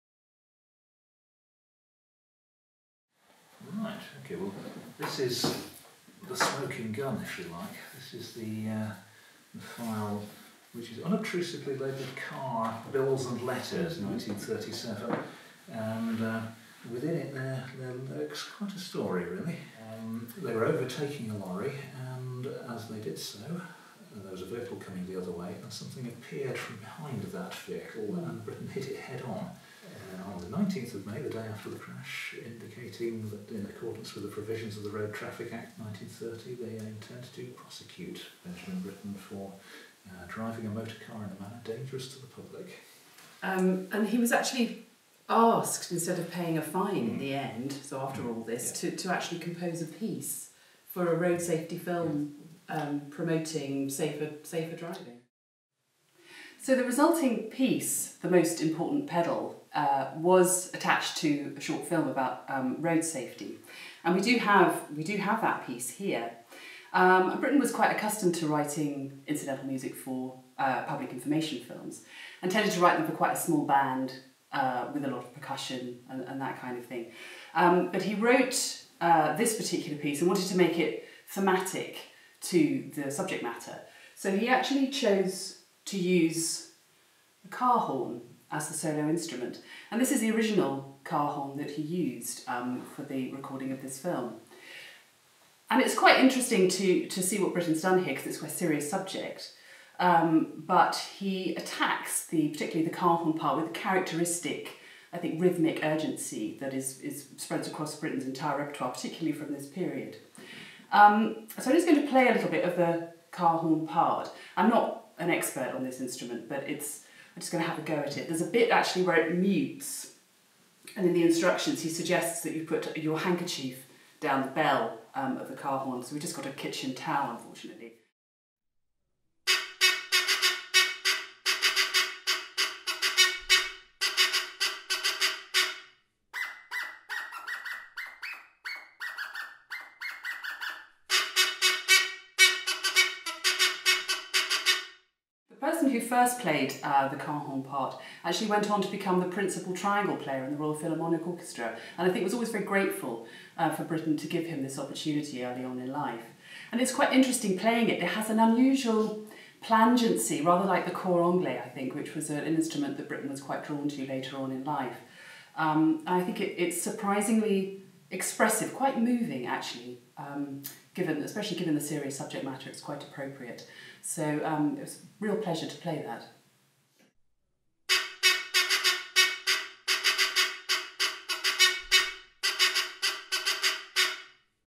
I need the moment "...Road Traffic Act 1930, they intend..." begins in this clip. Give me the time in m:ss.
0:34.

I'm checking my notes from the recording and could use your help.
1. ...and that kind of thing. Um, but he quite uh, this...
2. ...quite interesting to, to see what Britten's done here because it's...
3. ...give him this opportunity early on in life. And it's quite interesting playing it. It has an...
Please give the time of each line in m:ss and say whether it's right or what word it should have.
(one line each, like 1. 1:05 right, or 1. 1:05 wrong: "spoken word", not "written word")
1. 1:16 wrong: "wrote", not "quite"
2. 1:35 right
3. 2:34 right.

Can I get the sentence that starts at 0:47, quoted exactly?
in the end, so after all this, yeah.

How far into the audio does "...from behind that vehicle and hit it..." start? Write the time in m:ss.
0:26.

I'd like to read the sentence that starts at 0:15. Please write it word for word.
And uh, within it, there, there lurks quite a story, really.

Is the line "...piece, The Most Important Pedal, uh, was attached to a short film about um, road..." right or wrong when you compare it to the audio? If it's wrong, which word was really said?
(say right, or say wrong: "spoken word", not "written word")
right.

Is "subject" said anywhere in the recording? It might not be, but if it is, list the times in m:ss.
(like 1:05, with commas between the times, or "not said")
1:23, 1:38, 2:52.